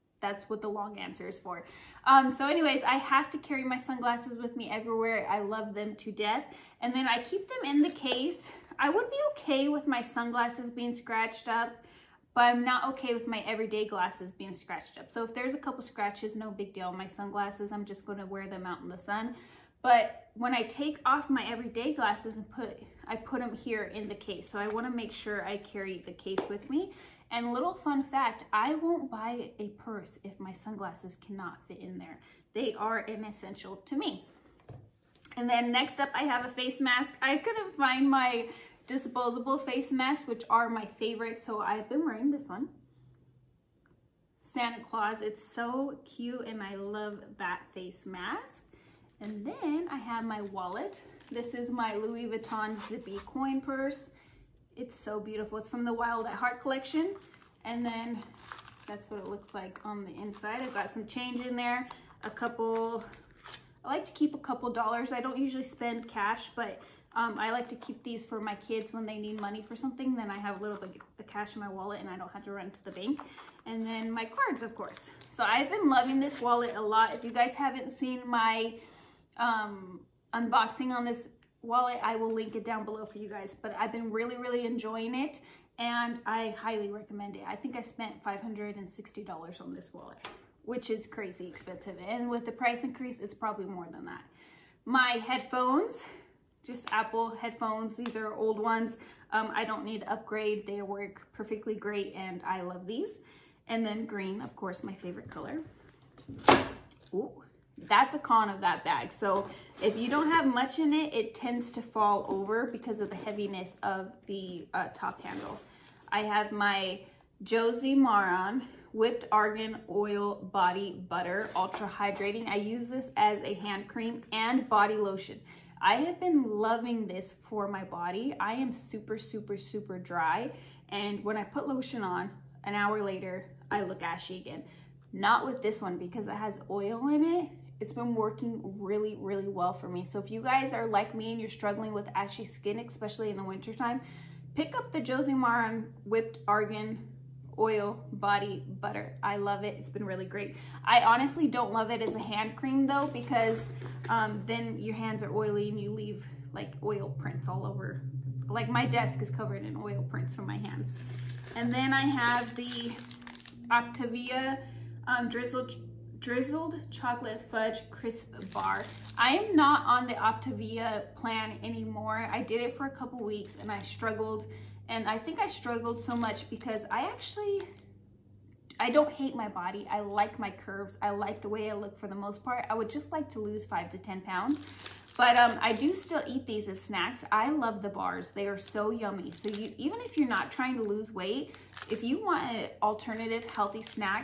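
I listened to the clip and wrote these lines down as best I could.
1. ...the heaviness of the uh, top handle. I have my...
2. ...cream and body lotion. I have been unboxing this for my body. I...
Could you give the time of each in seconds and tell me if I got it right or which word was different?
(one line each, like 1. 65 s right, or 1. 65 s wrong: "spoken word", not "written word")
1. 113 s right
2. 123 s wrong: "loving", not "unboxing".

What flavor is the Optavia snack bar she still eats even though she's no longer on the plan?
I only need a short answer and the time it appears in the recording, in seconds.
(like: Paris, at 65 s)
Drizzled chocolate fudge crisp, at 165 s.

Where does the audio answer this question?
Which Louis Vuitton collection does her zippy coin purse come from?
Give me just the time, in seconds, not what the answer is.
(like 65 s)
55 s.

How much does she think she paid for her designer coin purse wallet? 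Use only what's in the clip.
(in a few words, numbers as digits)
$560.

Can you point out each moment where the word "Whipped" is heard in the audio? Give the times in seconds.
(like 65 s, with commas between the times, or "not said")
118 s, 146 s.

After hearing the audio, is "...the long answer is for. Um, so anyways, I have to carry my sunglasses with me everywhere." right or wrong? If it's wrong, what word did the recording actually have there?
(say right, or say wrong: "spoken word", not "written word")
right.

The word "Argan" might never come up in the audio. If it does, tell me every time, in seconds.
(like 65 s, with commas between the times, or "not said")
119 s, 146 s.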